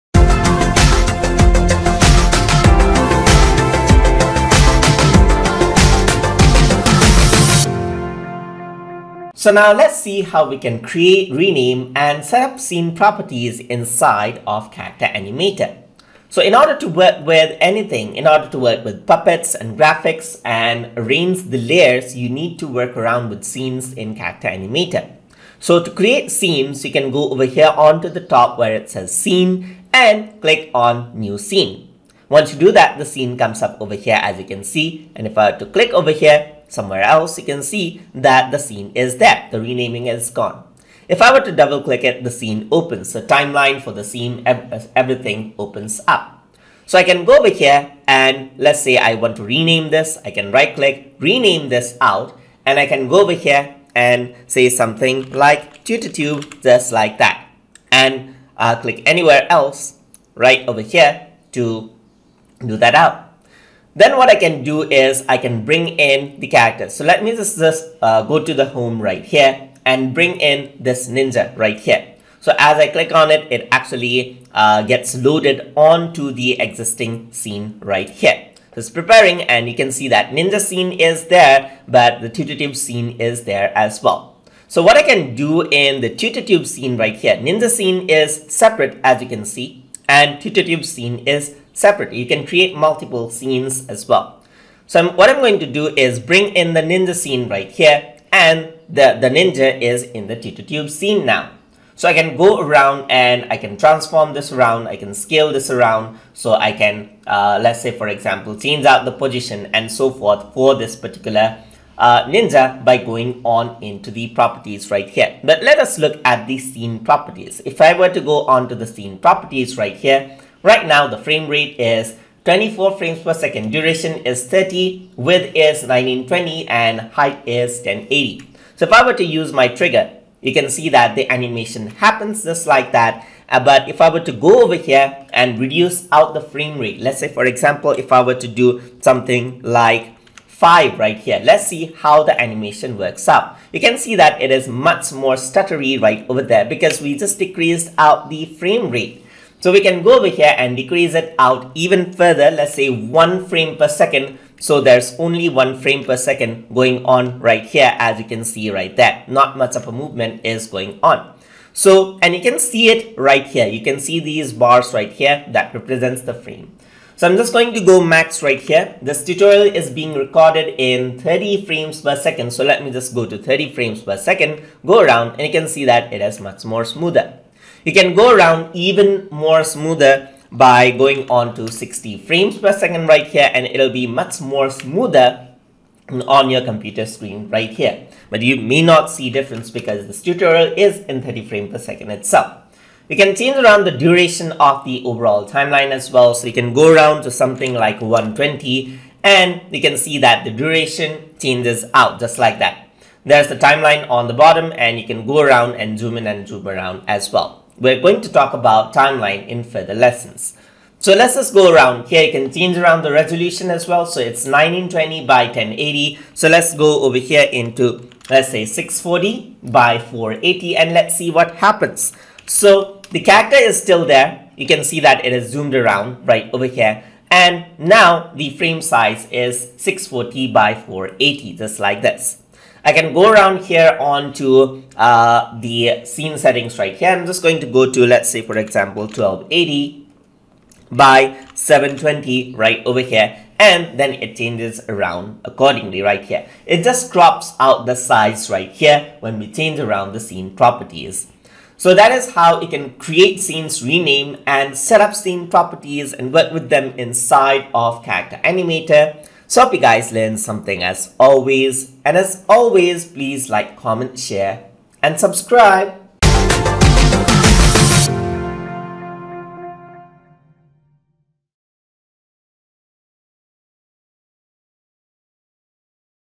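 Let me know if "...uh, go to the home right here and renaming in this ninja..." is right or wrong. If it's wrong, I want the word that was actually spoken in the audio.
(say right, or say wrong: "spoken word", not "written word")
wrong: "bring", not "renaming".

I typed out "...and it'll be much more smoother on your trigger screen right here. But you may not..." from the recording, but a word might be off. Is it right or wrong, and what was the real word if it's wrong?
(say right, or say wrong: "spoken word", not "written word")
wrong: "computer", not "trigger".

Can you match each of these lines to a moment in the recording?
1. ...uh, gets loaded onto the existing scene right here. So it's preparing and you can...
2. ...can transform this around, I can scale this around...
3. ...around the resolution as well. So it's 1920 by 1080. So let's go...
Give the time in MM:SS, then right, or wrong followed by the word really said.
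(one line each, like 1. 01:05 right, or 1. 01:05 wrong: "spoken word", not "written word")
1. 01:14 right
2. 01:43 right
3. 03:32 right.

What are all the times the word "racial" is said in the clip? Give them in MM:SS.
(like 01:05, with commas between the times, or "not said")
not said.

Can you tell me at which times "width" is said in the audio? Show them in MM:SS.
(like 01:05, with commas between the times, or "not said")
02:05.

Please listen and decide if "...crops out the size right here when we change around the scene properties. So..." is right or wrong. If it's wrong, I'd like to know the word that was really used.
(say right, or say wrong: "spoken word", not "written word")
right.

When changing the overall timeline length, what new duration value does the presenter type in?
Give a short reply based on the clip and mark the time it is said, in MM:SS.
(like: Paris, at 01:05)
120, at 03:17.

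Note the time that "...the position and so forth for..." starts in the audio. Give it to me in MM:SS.
01:49.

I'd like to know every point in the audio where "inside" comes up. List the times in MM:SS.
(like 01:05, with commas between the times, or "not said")
00:13, 04:16.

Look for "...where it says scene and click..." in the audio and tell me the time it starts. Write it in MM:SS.
00:28.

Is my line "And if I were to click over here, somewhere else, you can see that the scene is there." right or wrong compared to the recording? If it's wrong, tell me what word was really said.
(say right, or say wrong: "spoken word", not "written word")
right.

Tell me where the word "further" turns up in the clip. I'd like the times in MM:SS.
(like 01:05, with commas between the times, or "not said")
02:32, 03:29.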